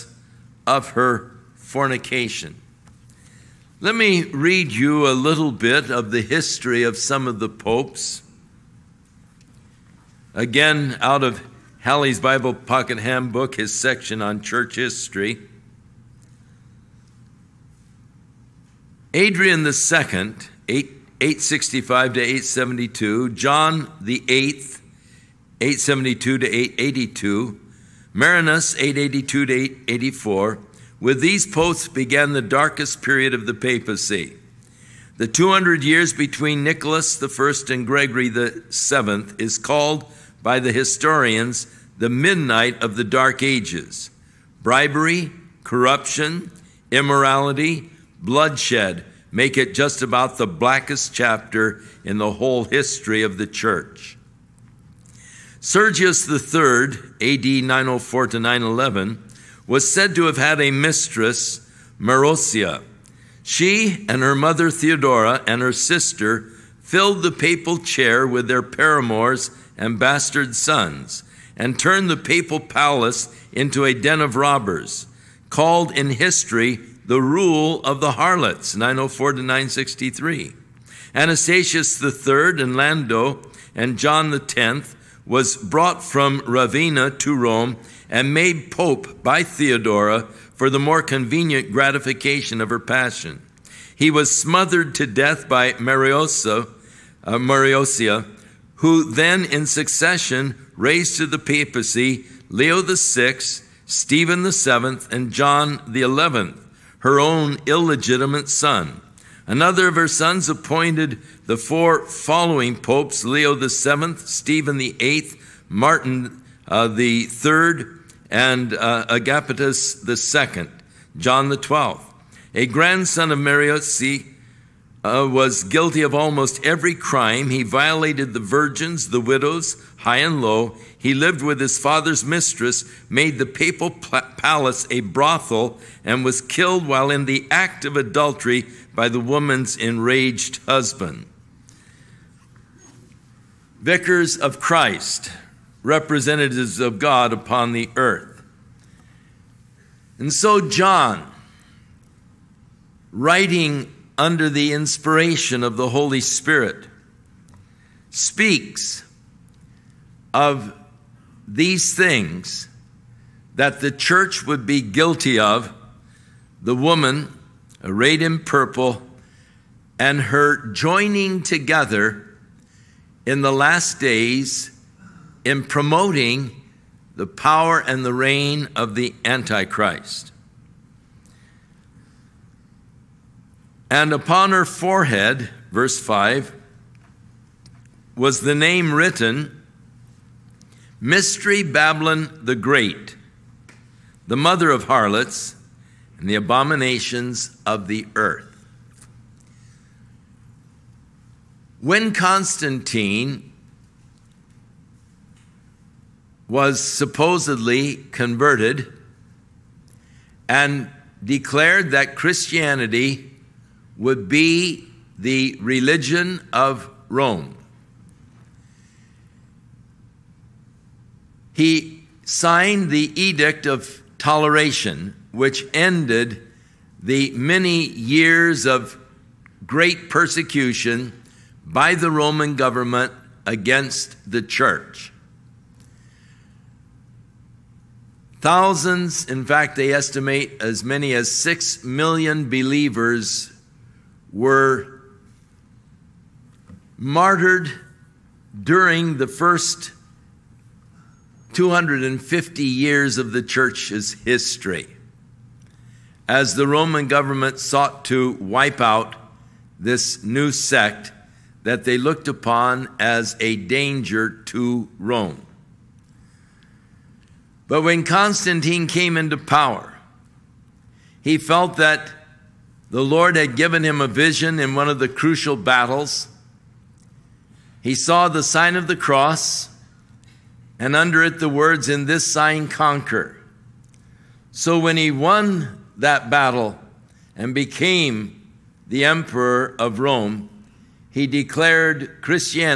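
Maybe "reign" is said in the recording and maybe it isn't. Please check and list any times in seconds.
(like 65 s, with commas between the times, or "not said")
178 s.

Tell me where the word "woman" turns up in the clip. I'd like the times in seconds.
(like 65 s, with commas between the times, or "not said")
139 s, 166 s.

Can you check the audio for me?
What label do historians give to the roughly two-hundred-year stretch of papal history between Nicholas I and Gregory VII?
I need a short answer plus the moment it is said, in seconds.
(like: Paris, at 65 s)
The midnight of the Dark Ages, at 41 s.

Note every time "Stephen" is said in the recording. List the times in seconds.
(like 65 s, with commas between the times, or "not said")
103 s, 114 s.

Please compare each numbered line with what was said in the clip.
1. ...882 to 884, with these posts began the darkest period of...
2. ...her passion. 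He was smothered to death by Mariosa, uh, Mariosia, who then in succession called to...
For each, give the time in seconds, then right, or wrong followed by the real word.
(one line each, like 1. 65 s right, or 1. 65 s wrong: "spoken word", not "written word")
1. 28 s right
2. 92 s wrong: "raised", not "called".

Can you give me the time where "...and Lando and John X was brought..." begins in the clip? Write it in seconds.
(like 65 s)
82 s.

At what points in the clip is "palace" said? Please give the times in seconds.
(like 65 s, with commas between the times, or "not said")
72 s, 133 s.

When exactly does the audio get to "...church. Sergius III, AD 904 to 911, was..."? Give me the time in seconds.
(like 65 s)
53 s.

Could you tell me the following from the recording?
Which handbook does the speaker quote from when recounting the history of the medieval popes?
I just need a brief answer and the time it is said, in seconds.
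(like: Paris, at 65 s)
Halley's Bible Pocket Handbook, at 11 s.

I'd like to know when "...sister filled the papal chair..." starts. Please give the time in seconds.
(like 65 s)
65 s.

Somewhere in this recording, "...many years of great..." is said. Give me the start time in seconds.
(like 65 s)
227 s.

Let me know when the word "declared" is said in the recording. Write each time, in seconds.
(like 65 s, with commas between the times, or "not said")
211 s, 291 s.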